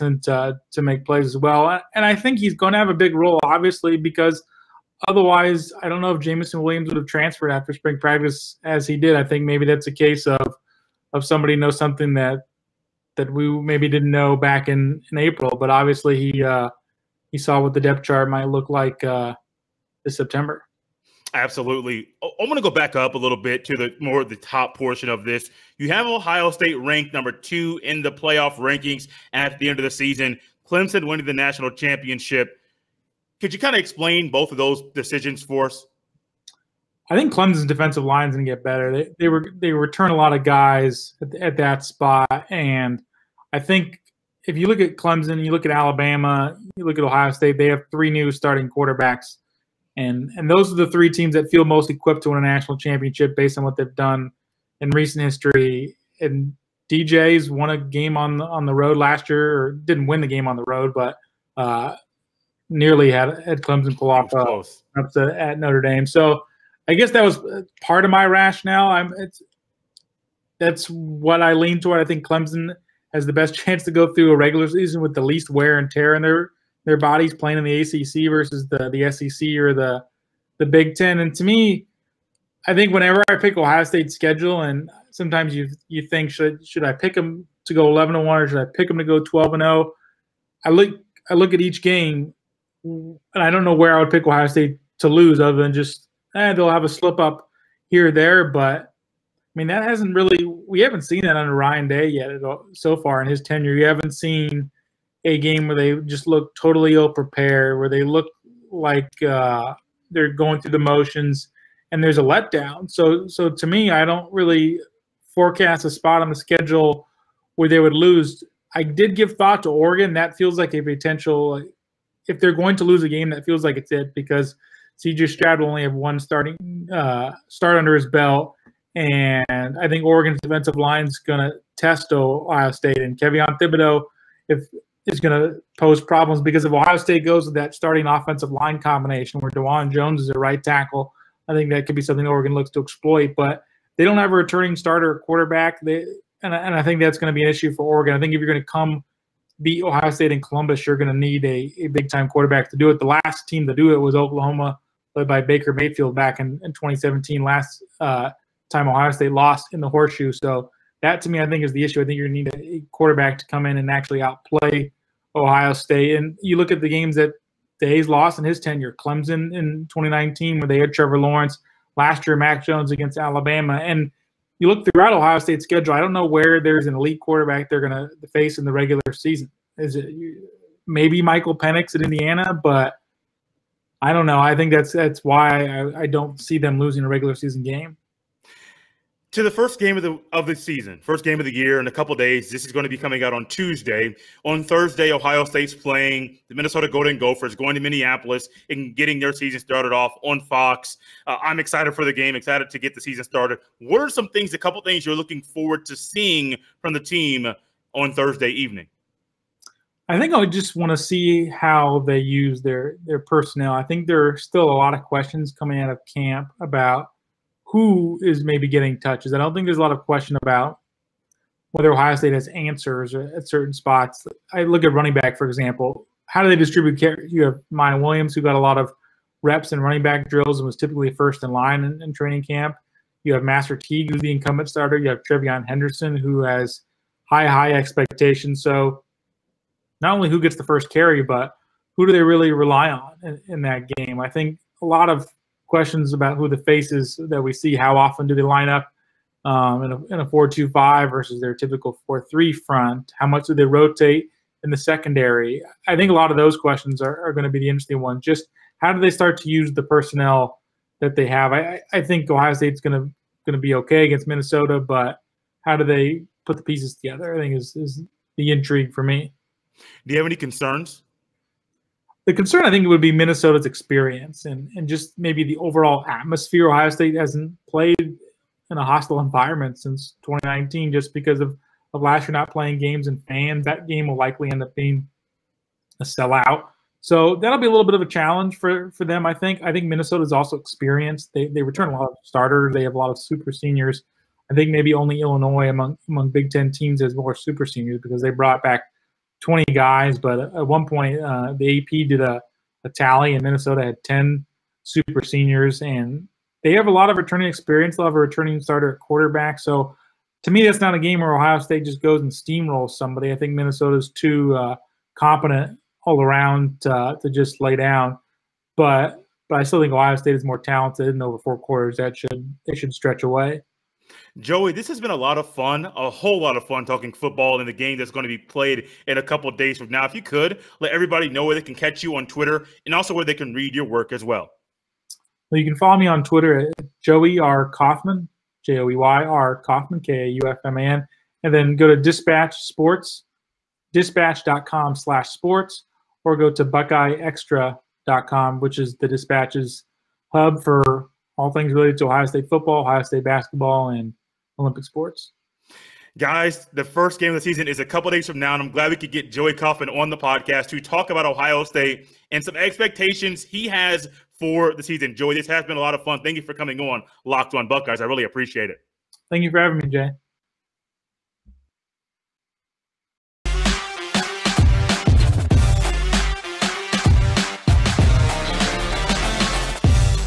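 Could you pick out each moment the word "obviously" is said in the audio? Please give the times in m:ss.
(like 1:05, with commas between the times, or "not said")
0:03, 0:15.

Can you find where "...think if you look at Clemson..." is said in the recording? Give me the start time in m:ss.
0:43.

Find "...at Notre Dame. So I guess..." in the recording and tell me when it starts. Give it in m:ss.
1:05.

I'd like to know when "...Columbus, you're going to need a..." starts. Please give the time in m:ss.
2:30.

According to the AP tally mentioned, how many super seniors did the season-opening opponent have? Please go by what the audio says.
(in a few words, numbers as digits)
10.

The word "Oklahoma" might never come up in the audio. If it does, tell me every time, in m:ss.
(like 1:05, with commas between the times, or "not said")
2:34.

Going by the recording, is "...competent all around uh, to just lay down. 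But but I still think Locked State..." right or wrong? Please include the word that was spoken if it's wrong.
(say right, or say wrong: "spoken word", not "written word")
wrong: "Ohio", not "Locked".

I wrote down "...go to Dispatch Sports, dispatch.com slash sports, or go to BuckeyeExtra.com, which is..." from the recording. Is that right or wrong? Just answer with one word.
right.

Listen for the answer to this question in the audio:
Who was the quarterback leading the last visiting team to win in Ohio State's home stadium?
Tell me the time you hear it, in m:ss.
2:35.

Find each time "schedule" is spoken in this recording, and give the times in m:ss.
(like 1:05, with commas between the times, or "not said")
1:24, 1:56, 2:55.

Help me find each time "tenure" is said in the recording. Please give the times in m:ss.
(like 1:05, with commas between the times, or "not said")
1:43, 2:48.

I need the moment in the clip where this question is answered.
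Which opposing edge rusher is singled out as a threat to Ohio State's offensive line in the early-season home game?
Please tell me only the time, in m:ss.
2:13.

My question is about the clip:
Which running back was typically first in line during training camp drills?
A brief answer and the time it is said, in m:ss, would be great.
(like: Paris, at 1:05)
Miyan Williams, at 3:47.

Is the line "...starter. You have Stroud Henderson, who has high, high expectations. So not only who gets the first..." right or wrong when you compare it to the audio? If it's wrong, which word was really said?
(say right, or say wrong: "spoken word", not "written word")
wrong: "TreVeyon", not "Stroud".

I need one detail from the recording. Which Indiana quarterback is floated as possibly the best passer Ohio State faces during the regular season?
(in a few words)
Michael Penix.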